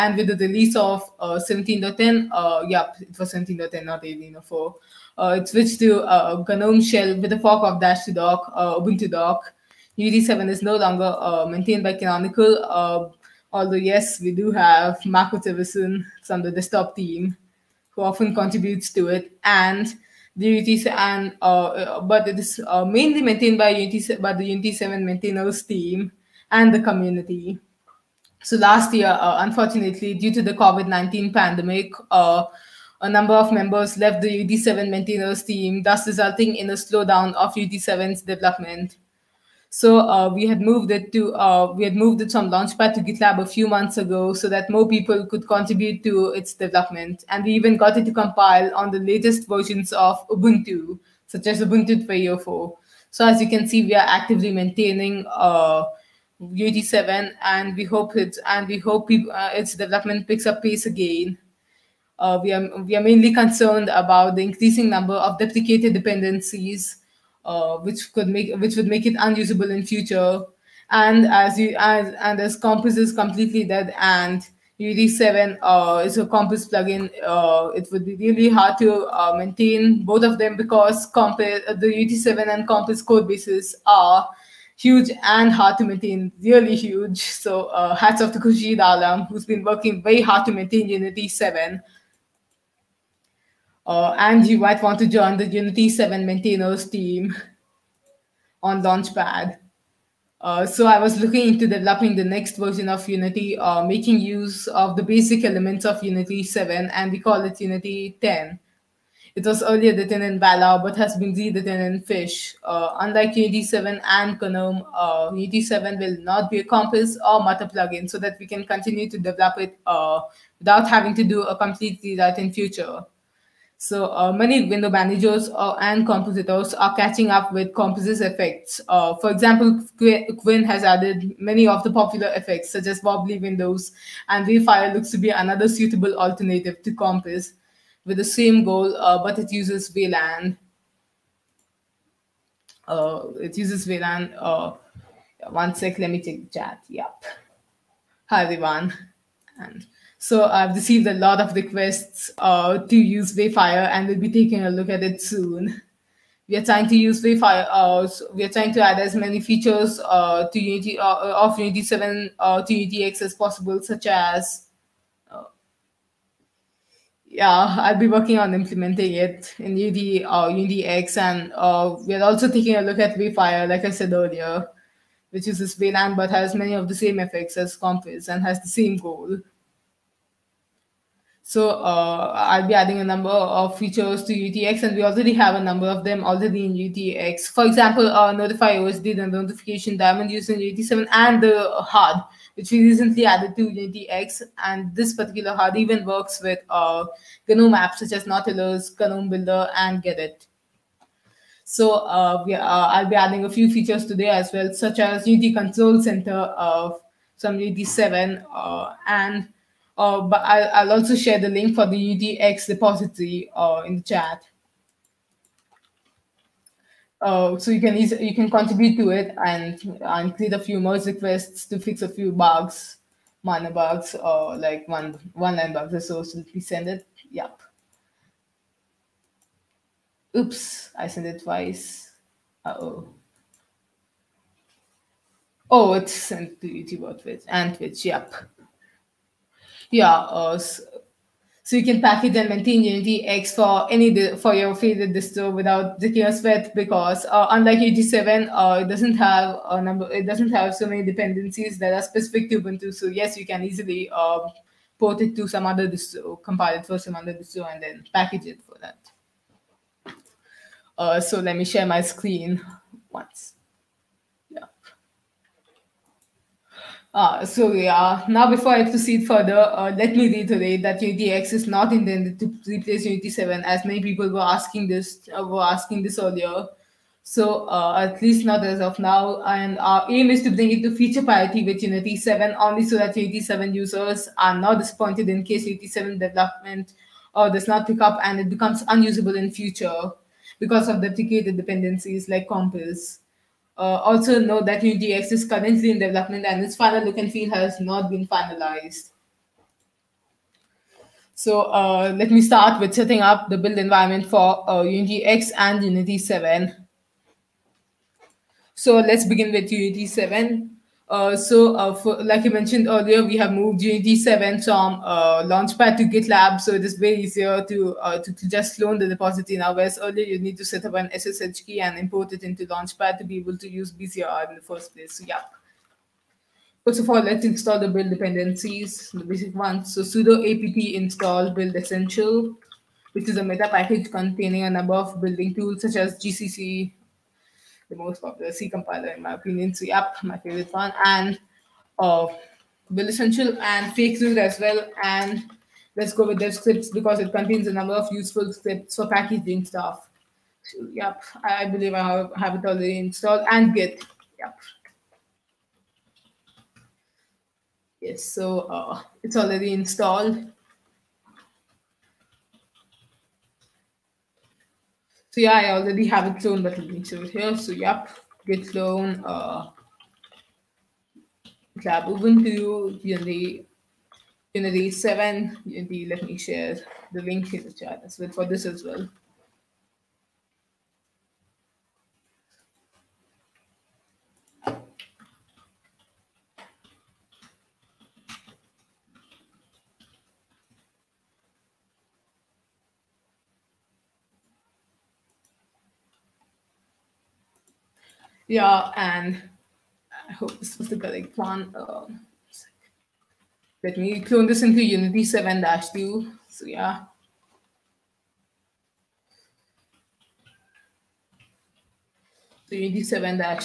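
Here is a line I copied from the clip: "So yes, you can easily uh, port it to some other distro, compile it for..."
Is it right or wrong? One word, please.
right.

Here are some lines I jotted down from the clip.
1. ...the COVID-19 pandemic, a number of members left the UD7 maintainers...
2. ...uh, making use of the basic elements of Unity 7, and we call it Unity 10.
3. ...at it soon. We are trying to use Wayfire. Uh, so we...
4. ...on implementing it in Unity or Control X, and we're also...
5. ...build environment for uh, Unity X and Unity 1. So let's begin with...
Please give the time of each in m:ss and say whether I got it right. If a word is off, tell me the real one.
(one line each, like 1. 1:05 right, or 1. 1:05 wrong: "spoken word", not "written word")
1. 0:30 right
2. 1:43 right
3. 2:34 right
4. 2:48 wrong: "Unity", not "Control"
5. 5:03 wrong: "7", not "1".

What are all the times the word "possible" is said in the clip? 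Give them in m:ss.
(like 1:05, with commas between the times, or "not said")
2:43.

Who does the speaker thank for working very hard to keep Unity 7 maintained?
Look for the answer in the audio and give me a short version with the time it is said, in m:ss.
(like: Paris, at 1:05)
Khurshid Alam, at 1:28.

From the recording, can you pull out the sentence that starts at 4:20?
Uh, so let me share my screen once.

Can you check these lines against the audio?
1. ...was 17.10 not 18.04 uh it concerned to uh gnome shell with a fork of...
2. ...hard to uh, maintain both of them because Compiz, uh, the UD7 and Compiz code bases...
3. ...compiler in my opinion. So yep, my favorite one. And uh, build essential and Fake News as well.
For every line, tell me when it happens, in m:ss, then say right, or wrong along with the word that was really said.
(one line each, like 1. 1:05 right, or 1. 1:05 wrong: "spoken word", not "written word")
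1. 0:03 wrong: "switched", not "concerned"
2. 1:18 right
3. 5:38 right.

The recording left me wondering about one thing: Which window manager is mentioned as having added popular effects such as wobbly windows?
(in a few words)
KWin.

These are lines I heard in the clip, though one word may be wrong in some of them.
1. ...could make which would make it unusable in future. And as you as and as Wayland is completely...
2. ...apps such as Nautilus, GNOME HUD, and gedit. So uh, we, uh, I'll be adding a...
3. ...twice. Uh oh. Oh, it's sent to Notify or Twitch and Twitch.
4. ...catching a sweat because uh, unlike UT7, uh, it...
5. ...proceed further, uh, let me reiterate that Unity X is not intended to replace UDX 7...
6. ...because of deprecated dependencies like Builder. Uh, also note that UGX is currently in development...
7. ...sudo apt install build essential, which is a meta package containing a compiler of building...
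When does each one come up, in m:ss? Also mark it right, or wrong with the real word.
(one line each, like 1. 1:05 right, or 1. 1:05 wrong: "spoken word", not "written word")
1. 1:08 wrong: "Compiz", not "Wayland"
2. 3:17 wrong: "Builder", not "HUD"
3. 3:51 wrong: "YouTube", not "Notify"
4. 4:05 wrong: "taking", not "catching"
5. 4:28 wrong: "Unity", not "UDX"
6. 4:50 wrong: "Compiz", not "Builder"
7. 5:30 wrong: "number", not "compiler".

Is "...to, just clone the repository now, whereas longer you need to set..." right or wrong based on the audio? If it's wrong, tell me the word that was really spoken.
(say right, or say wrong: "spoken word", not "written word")
wrong: "earlier", not "longer".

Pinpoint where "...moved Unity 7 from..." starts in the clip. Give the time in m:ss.
5:13.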